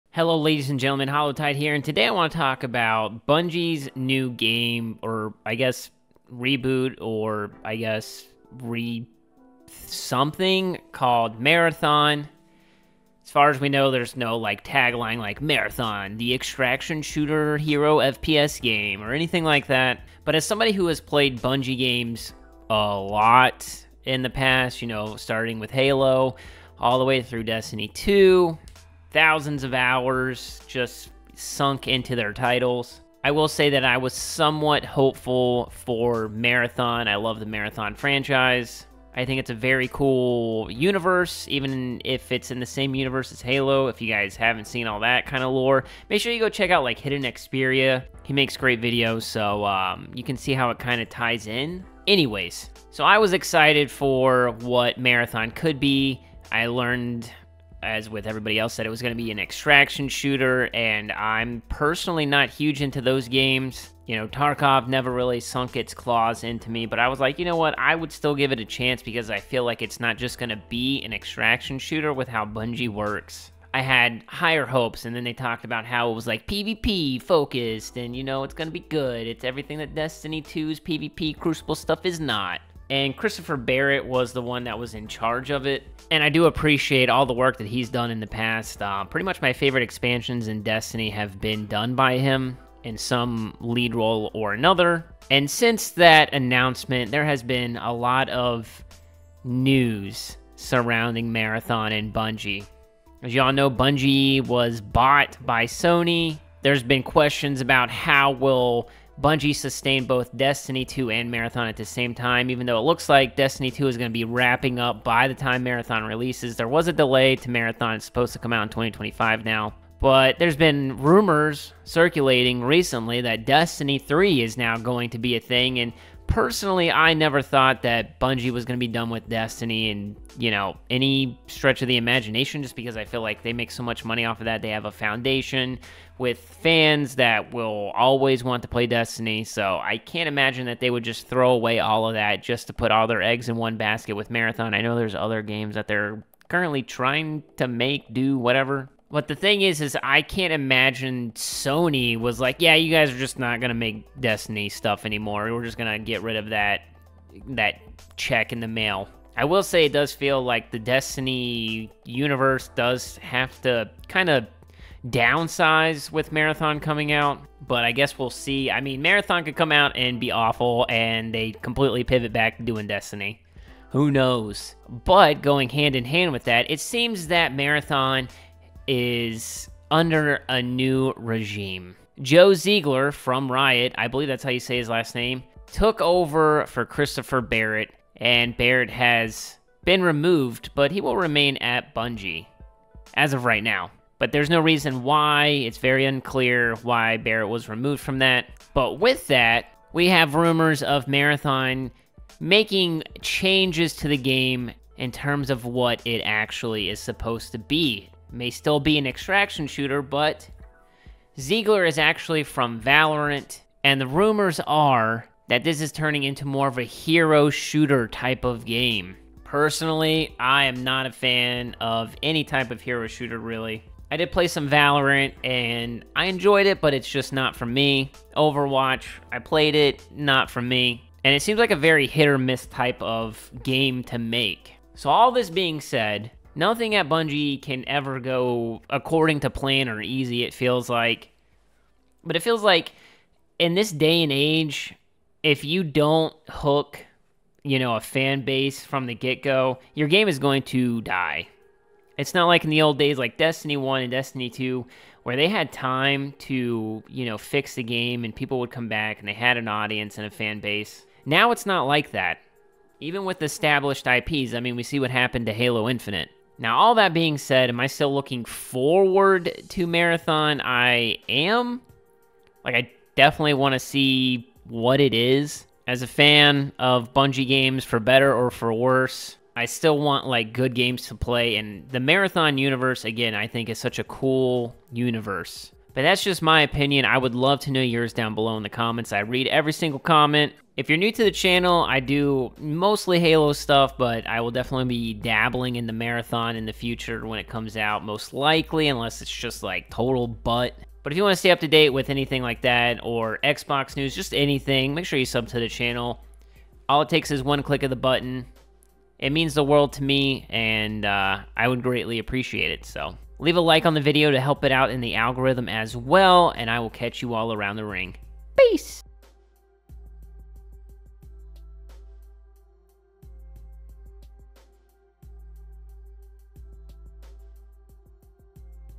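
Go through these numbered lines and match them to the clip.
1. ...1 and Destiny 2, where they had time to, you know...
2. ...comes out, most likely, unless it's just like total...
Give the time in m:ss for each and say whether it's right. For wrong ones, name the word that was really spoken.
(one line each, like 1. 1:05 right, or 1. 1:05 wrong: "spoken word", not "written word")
1. 4:13 right
2. 4:57 right.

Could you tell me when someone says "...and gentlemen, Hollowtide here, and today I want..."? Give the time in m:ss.
0:00.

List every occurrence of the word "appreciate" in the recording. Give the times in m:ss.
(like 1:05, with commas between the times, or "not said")
1:26, 5:12.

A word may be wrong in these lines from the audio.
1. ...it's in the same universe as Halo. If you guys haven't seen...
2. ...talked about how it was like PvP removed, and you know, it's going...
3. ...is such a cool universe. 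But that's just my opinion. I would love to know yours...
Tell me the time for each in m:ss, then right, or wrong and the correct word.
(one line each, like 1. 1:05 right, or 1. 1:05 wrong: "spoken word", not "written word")
1. 0:42 right
2. 1:15 wrong: "focused", not "removed"
3. 4:43 right.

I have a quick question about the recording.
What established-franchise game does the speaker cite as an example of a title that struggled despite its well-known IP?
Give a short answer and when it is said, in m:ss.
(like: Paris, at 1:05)
Halo Infinite, at 4:25.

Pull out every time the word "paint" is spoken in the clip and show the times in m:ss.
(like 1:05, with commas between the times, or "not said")
not said.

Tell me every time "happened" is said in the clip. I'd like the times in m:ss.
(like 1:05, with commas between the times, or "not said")
4:25.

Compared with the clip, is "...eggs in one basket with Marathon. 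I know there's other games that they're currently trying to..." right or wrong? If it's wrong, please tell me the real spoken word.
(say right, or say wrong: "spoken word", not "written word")
right.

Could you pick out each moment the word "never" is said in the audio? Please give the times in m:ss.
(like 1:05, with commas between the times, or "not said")
1:04, 2:07.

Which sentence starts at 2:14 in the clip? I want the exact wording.
They have a foundation with fans that will always want to play Destiny.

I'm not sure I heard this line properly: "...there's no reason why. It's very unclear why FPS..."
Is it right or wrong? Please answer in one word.
wrong.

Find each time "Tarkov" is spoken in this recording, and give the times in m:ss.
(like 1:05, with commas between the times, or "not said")
1:04.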